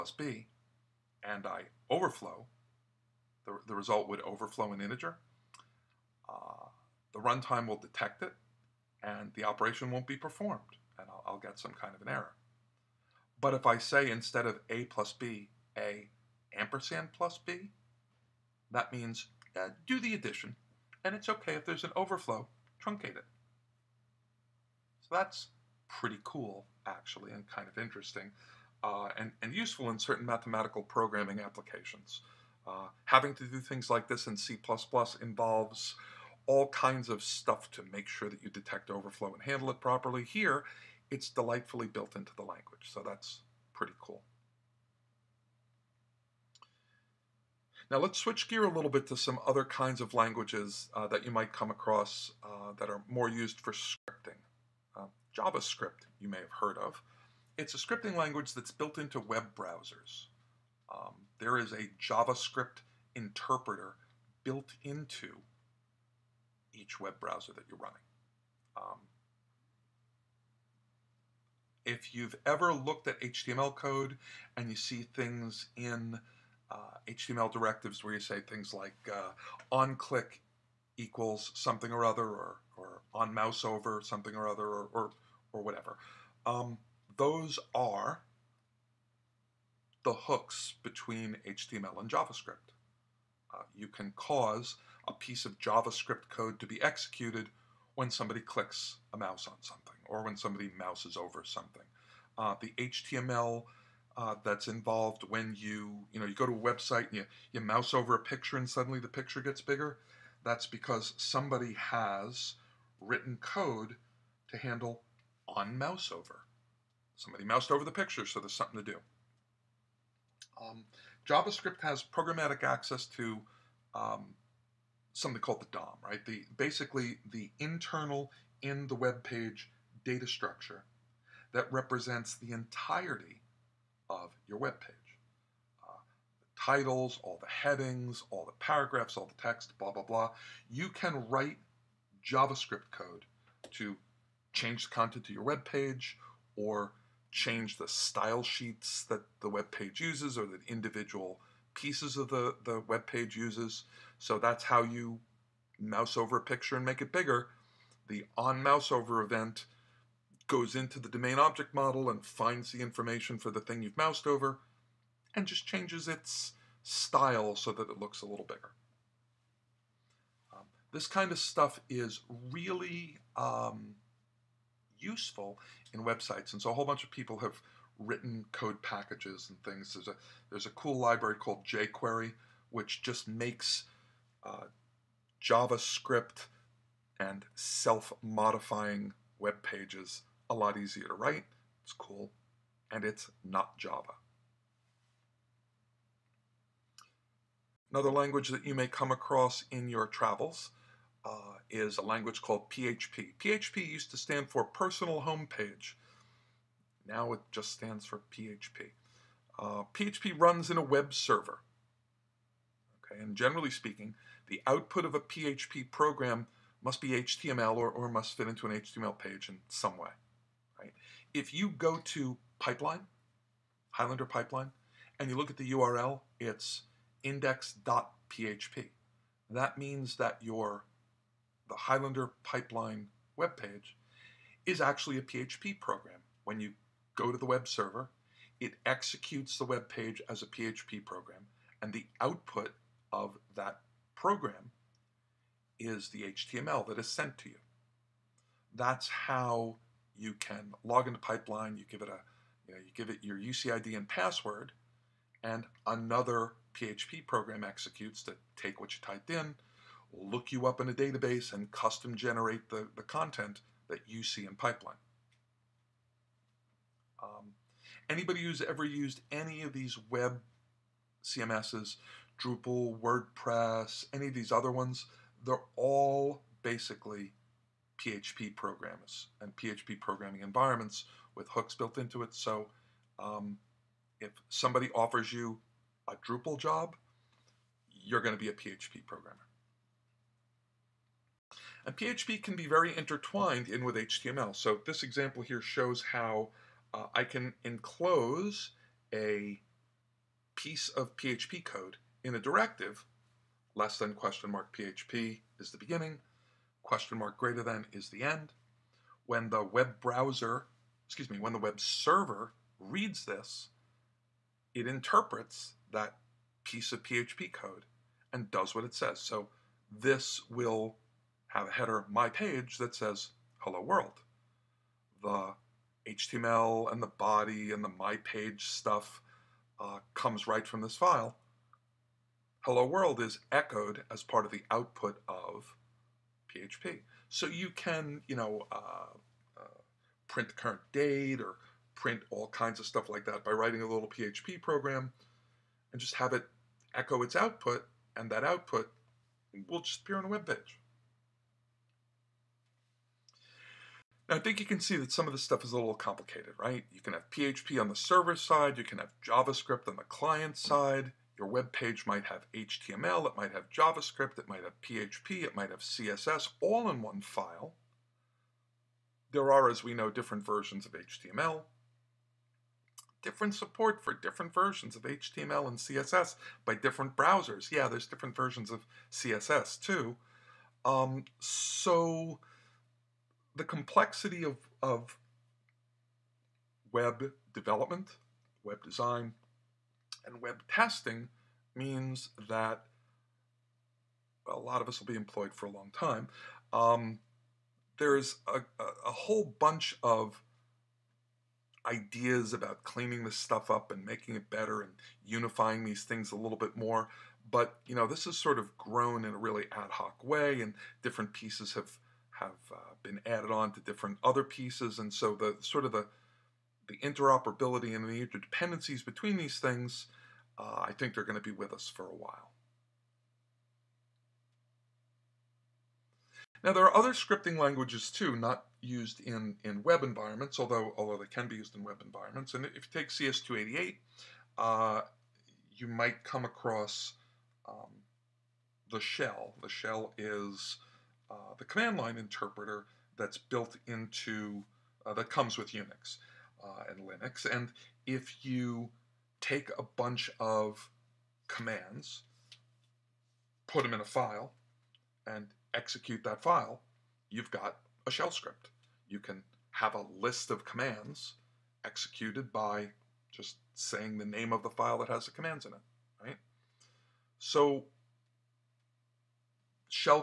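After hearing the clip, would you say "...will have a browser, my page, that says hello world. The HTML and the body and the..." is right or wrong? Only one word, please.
wrong.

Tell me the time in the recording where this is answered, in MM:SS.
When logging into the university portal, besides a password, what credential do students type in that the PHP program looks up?
04:13.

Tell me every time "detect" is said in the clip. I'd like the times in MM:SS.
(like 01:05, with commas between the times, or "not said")
00:07, 00:38.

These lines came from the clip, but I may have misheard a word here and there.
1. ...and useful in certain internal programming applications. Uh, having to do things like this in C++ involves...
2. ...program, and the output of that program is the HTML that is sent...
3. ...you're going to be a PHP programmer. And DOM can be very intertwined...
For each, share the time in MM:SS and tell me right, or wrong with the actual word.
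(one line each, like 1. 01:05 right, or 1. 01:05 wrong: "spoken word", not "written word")
1. 00:29 wrong: "mathematical", not "internal"
2. 04:01 right
3. 04:48 wrong: "PHP", not "DOM".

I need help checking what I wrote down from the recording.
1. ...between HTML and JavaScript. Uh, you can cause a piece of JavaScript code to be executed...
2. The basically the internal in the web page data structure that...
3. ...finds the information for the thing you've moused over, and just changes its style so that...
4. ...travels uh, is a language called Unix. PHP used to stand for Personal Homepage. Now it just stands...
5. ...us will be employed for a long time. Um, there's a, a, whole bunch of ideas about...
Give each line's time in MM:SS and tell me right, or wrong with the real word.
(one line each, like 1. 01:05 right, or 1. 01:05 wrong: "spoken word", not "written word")
1. 01:30 right
2. 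02:06 right
3. 02:42 right
4. 03:20 wrong: "PHP", not "Unix"
5. 06:34 right.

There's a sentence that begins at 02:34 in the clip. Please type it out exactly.
So that's how you mouse over a picture and make it bigger.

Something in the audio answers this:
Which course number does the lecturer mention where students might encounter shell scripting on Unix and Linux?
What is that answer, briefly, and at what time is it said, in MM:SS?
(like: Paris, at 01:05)
CS288, at 07:13.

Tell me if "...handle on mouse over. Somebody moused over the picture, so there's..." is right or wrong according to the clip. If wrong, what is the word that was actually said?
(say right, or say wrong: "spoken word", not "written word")
right.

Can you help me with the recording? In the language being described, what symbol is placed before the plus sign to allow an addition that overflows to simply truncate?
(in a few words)
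ampersand.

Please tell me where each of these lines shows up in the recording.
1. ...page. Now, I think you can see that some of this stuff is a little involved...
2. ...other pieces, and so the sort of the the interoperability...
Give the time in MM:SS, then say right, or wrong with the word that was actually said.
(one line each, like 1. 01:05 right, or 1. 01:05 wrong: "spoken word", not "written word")
1. 05:50 wrong: "complicated", not "involved"
2. 06:54 right.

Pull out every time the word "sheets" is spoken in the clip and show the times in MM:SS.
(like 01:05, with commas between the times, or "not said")
02:28.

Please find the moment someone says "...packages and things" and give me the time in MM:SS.
02:58.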